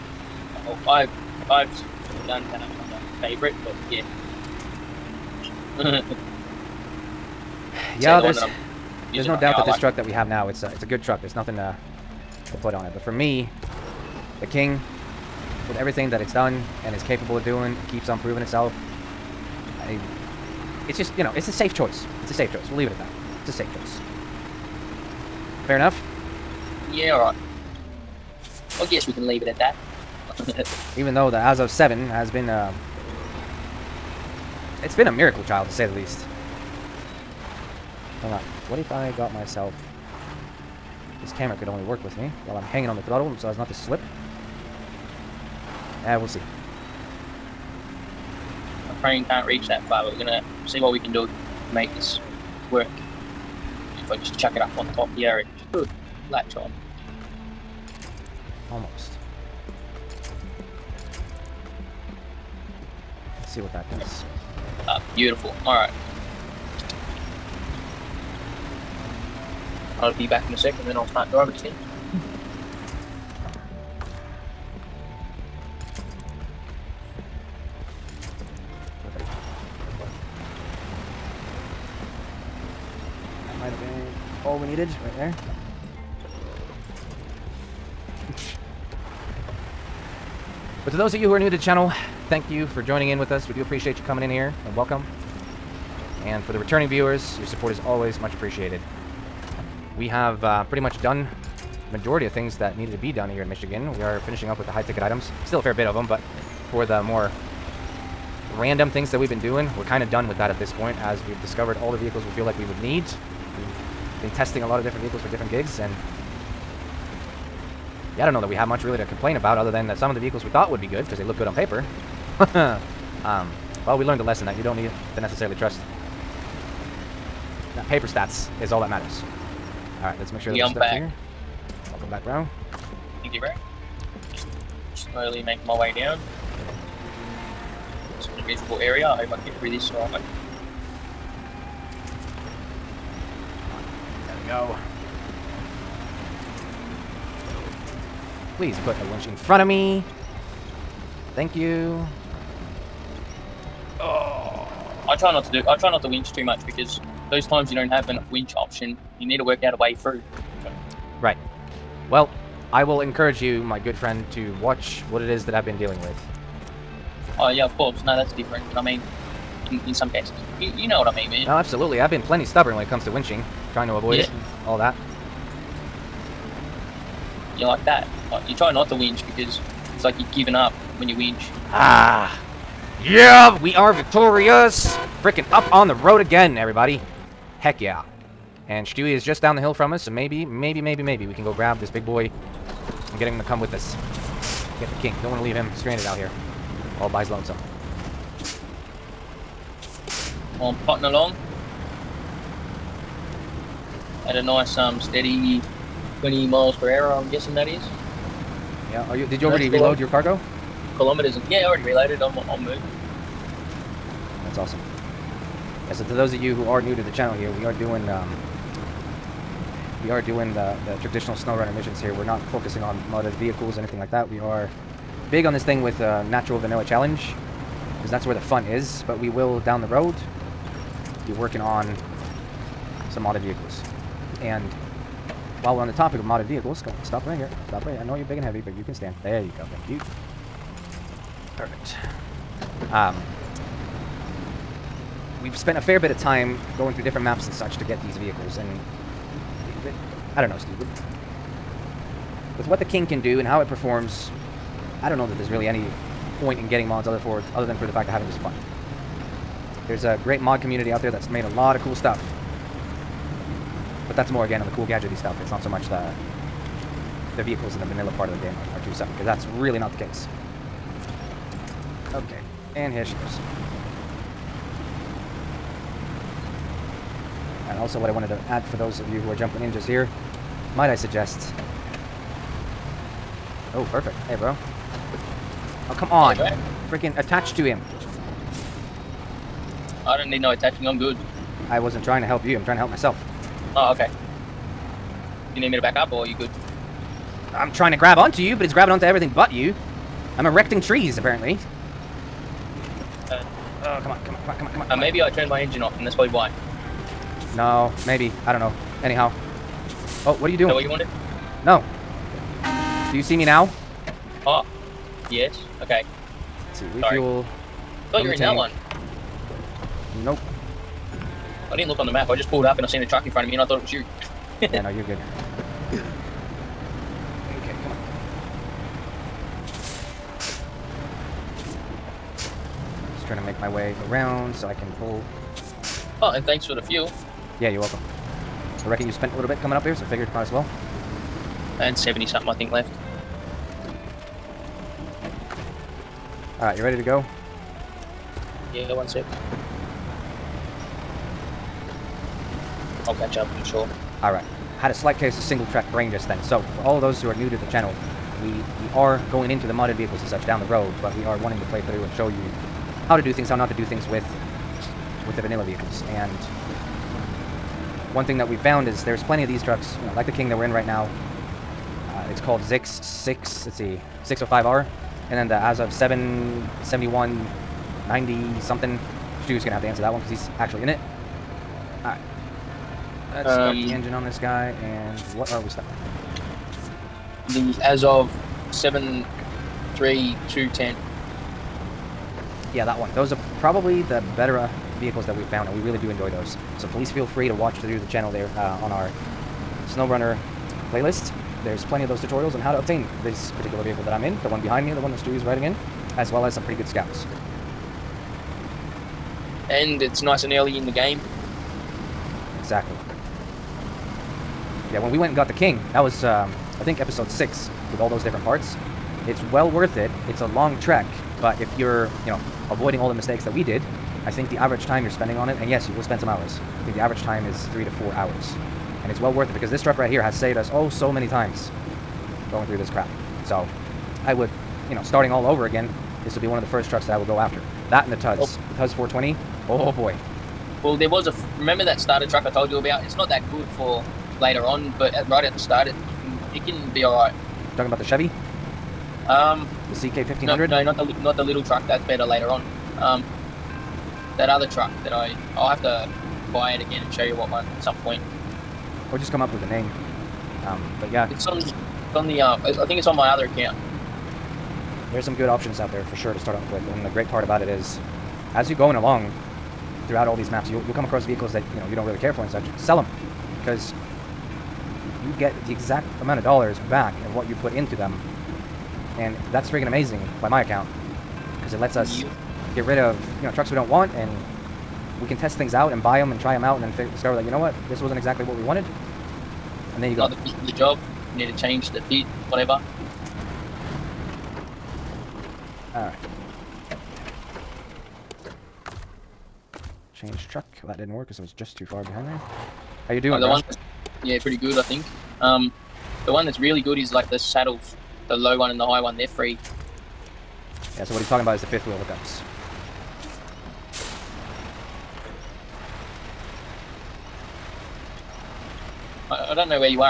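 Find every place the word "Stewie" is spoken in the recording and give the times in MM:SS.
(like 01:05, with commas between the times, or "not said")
03:08, 06:45.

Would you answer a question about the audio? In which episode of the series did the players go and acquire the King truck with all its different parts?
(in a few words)
Episode 6.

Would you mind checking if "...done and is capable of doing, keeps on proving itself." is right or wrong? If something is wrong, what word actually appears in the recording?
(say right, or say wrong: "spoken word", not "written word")
right.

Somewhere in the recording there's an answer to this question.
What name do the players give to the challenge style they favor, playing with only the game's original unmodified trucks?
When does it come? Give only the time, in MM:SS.
03:46.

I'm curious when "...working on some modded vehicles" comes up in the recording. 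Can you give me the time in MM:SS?
03:51.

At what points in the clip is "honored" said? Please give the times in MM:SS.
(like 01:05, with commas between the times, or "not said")
not said.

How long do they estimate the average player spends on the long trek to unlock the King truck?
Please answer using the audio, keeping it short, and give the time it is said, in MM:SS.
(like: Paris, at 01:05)
3 to 4 hours, at 07:07.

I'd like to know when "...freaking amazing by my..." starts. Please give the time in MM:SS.
07:59.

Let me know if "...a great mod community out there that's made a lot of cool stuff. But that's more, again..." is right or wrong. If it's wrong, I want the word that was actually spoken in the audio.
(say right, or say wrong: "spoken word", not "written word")
right.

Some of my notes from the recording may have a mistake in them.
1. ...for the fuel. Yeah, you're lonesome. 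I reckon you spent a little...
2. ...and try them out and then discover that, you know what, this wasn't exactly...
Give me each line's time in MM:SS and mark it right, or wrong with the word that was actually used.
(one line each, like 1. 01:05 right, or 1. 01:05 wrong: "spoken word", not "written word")
1. 05:36 wrong: "welcome", not "lonesome"
2. 08:06 right.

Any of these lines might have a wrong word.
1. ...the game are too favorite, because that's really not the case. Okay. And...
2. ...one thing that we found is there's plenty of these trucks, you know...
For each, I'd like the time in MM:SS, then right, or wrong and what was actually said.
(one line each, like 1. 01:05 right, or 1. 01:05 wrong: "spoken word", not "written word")
1. 04:28 wrong: "separate", not "favorite"
2. 06:08 right.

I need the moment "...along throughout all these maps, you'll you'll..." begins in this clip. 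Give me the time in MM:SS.
07:48.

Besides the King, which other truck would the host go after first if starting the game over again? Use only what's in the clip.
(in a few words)
Tuz 420.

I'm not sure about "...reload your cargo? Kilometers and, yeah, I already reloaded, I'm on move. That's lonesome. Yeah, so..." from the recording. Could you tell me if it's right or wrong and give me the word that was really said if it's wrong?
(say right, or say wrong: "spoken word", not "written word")
wrong: "awesome", not "lonesome".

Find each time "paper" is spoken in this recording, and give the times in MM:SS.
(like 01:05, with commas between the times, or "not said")
02:01, 02:07.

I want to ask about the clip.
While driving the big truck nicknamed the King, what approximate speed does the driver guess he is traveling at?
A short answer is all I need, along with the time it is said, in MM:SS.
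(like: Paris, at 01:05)
20 miles per hour, at 03:26.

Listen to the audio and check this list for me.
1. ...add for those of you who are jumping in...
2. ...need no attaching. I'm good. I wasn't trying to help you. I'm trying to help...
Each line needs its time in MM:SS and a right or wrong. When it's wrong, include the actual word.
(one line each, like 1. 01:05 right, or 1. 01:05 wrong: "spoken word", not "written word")
1. 04:38 right
2. 04:50 right.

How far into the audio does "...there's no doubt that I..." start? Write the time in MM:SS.
00:09.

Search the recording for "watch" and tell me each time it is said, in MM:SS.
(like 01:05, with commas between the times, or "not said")
02:44, 06:37.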